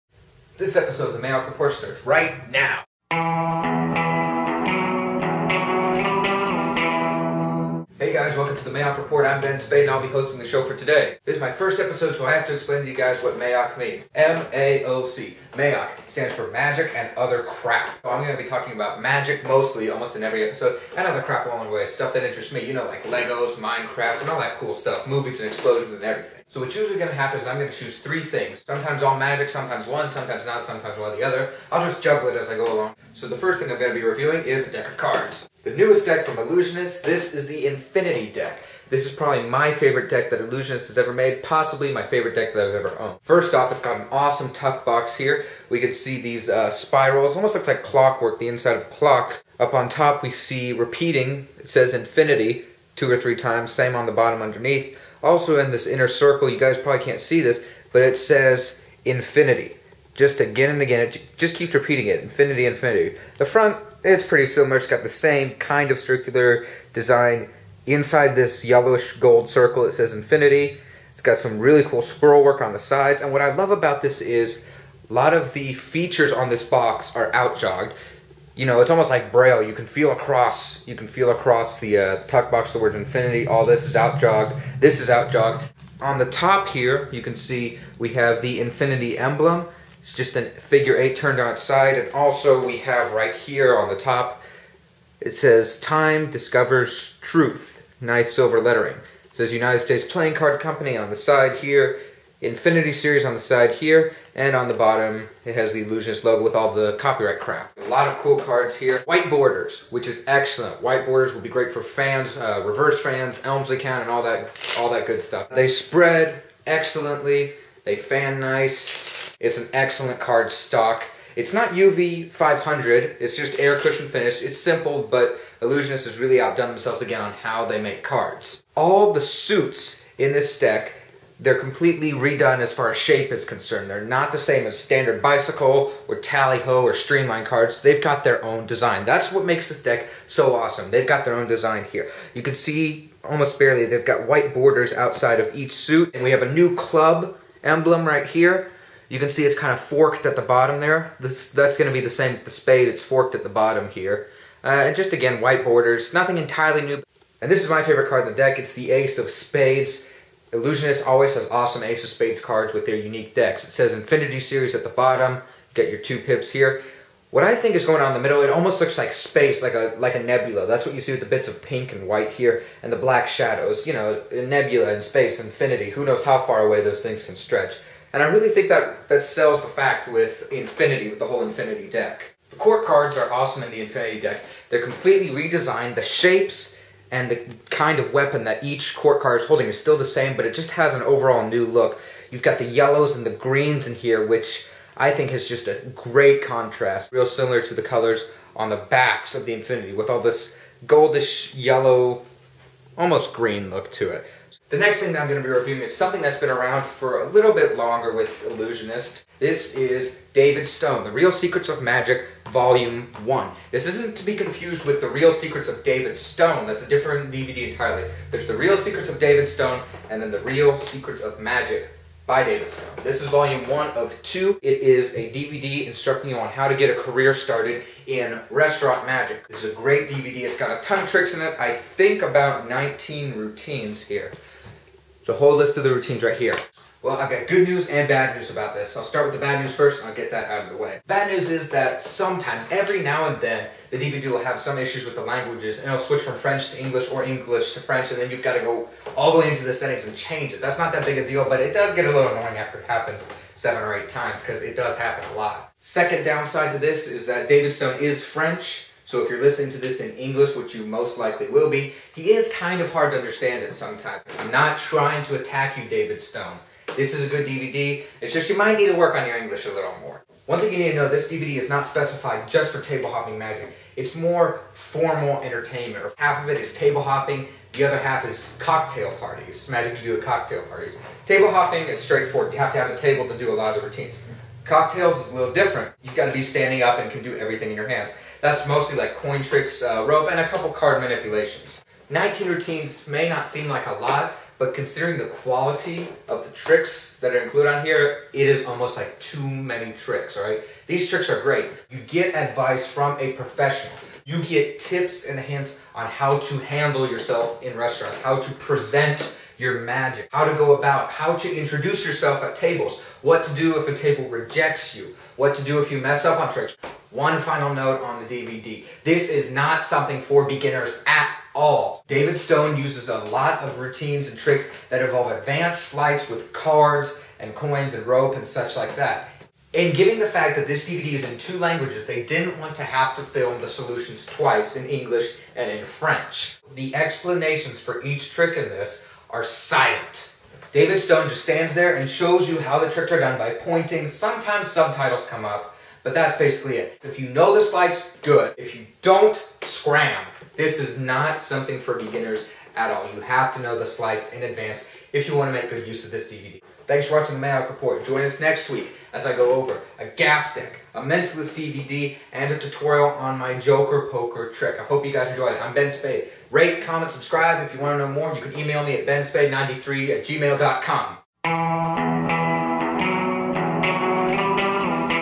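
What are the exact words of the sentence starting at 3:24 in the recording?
The next thing that I'm going to be reviewing is something that's been around for a little bit longer with Ellusionist.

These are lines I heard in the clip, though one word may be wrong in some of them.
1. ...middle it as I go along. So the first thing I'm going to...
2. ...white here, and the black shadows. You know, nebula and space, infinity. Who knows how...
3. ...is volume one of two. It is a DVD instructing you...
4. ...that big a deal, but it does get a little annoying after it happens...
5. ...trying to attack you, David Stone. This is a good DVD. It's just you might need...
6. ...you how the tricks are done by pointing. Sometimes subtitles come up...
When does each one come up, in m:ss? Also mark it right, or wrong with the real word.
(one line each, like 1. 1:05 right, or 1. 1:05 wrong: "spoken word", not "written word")
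1. 0:32 wrong: "juggle", not "middle"
2. 2:52 right
3. 3:43 right
4. 4:10 right
5. 4:24 right
6. 5:42 right.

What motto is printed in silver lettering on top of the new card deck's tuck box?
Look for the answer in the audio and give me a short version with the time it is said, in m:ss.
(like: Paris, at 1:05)
Time discovers truth, at 1:35.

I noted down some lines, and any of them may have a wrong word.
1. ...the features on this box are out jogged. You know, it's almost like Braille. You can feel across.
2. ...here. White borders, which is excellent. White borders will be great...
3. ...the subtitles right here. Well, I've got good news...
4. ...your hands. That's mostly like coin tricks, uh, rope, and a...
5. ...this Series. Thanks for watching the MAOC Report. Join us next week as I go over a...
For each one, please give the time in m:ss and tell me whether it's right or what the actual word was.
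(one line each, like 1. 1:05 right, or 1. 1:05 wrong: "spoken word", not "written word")
1. 1:15 right
2. 1:48 right
3. 3:55 wrong: "routines", not "subtitles"
4. 4:47 right
5. 5:56 wrong: "DVD", not "Series".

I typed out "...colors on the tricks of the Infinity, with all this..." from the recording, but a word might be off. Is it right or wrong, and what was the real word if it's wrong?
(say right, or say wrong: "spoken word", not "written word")
wrong: "backs", not "tricks".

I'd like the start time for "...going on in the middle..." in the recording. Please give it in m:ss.
2:47.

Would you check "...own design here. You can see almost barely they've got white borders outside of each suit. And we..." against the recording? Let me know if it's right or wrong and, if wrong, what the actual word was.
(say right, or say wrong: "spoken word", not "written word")
right.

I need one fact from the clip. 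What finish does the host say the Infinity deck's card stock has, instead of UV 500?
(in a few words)
Air cushion finish.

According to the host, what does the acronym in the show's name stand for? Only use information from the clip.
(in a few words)
Magic and other crap.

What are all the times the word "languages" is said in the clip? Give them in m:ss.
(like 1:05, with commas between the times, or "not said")
4:05, 5:31.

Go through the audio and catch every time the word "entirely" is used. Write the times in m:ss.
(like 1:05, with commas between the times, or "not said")
2:36, 3:37.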